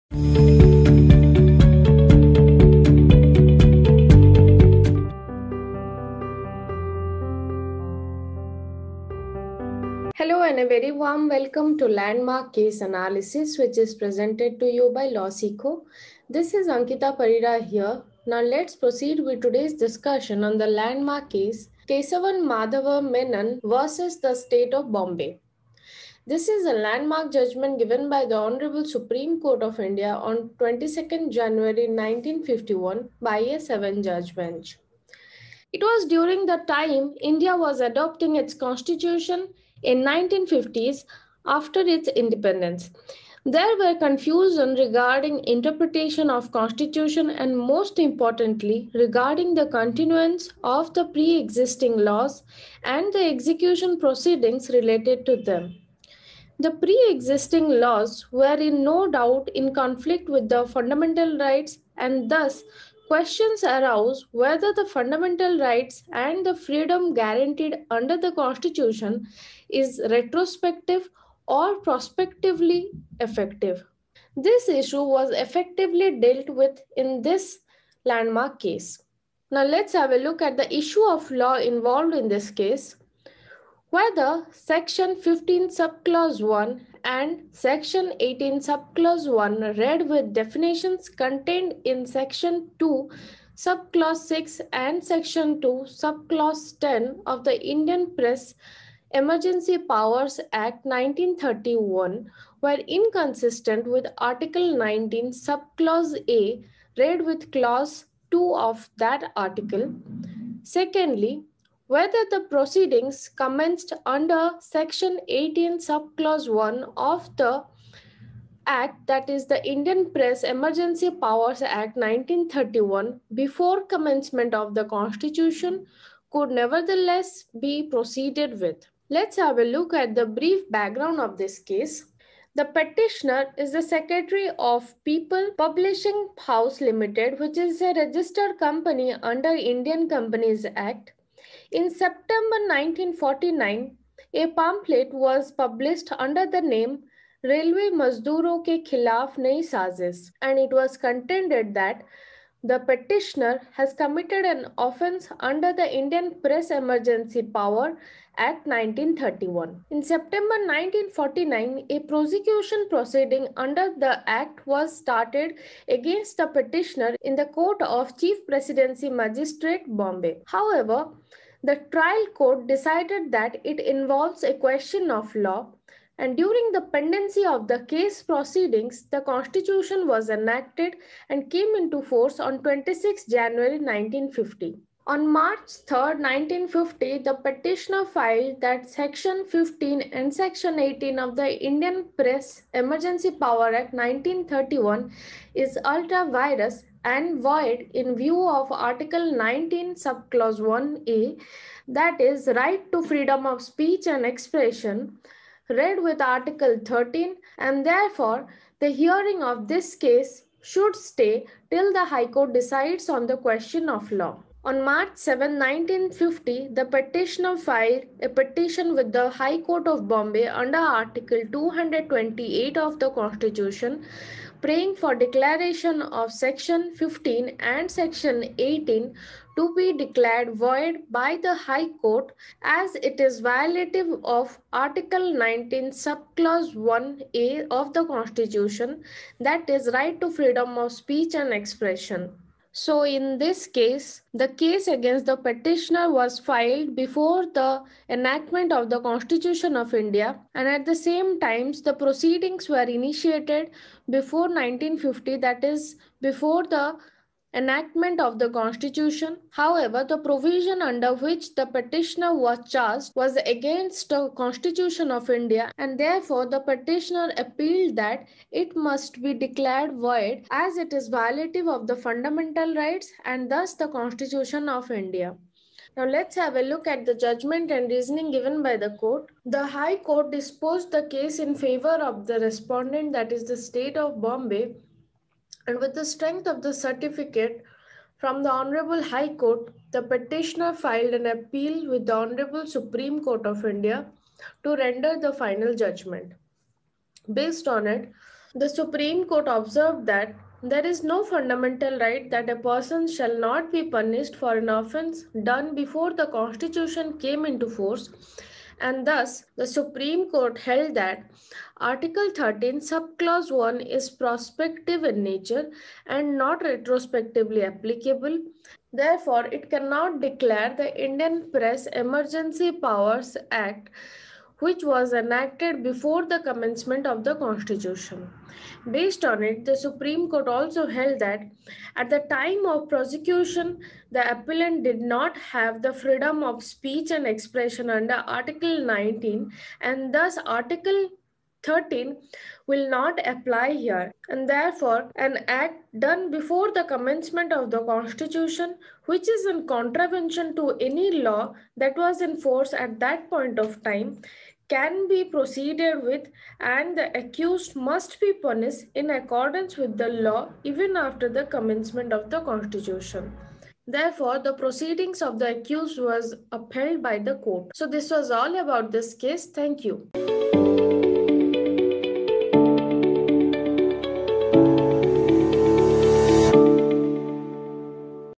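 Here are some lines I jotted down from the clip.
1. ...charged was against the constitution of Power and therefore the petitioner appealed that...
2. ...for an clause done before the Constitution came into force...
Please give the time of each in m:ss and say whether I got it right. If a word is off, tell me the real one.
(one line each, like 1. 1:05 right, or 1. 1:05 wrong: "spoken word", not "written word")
1. 4:22 wrong: "India", not "Power"
2. 5:04 wrong: "offense", not "clause".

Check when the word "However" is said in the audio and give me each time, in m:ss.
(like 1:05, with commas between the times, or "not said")
2:50, 4:19.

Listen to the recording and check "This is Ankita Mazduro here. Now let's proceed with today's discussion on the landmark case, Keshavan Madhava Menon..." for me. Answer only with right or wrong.
wrong.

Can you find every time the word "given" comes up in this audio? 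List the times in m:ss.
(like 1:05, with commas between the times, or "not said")
0:27, 4:38.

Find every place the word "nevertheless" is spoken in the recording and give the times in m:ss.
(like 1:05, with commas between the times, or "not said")
2:06.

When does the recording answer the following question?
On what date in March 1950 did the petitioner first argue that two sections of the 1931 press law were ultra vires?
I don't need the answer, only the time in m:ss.
3:05.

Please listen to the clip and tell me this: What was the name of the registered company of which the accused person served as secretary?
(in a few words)
People Publishing House Limited.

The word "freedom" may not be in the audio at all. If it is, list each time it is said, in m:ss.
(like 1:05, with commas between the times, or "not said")
1:06, 3:23, 4:00, 5:35.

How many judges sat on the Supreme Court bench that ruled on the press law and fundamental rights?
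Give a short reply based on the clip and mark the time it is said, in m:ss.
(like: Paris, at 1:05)
7, at 0:33.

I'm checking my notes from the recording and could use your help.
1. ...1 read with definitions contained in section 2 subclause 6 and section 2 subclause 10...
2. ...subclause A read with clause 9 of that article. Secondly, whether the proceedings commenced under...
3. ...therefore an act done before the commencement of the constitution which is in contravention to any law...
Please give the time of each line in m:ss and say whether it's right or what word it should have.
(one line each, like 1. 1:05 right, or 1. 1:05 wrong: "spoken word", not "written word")
1. 1:29 right
2. 1:45 wrong: "2", not "9"
3. 5:44 right.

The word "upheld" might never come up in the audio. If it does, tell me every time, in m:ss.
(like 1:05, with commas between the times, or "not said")
6:06.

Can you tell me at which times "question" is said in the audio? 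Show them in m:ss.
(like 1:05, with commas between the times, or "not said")
1:03, 2:54, 3:33.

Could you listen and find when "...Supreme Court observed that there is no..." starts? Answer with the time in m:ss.
4:58.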